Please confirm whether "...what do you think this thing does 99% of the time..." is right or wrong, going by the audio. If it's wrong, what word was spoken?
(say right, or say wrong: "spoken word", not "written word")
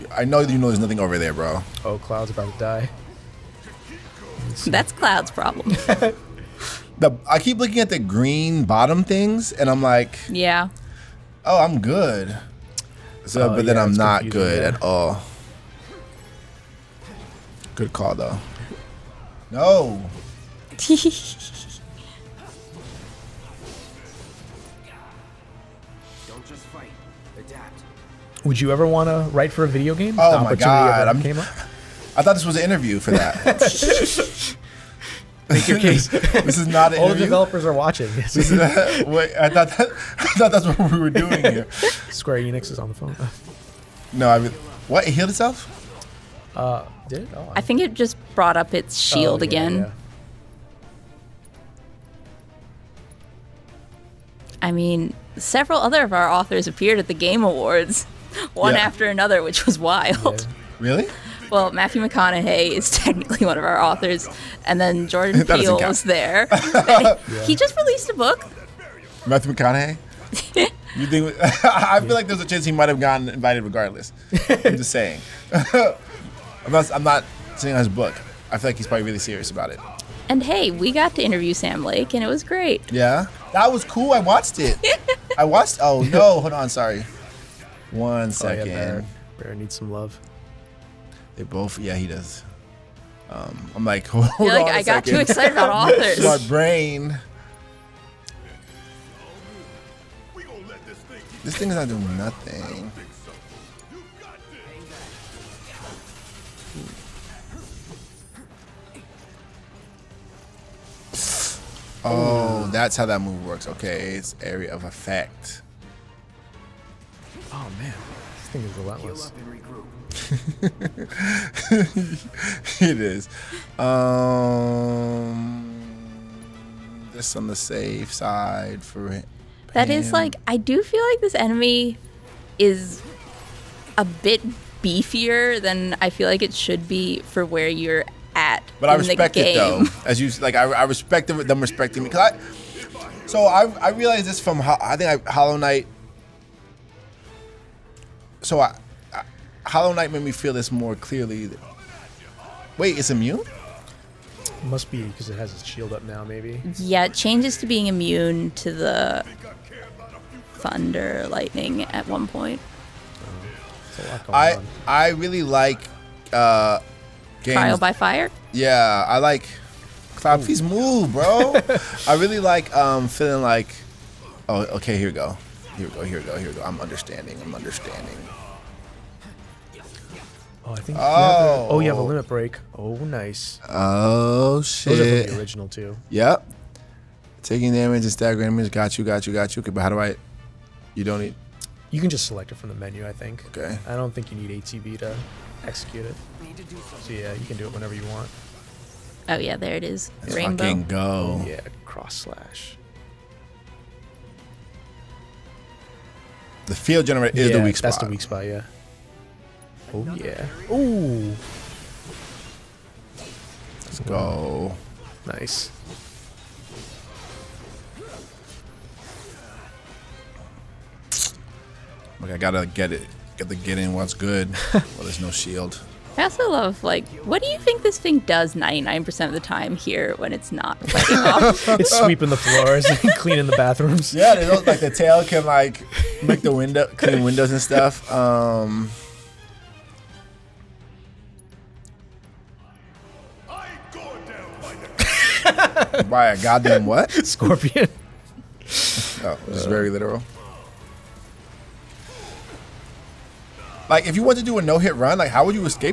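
right.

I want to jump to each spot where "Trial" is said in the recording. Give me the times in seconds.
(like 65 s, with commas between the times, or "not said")
167 s.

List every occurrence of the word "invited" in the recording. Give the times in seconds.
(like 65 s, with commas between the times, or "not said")
73 s.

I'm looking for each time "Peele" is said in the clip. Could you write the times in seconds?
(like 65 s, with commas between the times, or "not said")
65 s.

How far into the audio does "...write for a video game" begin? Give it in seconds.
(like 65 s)
29 s.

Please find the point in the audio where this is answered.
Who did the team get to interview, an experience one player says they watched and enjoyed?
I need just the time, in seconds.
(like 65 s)
81 s.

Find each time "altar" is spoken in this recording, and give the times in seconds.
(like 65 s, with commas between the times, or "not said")
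not said.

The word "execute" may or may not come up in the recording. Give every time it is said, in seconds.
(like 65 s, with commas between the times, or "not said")
195 s.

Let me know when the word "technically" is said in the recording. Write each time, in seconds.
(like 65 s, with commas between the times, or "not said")
62 s.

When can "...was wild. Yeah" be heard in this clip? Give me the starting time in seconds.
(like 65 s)
59 s.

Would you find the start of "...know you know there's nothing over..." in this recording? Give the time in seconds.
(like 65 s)
0 s.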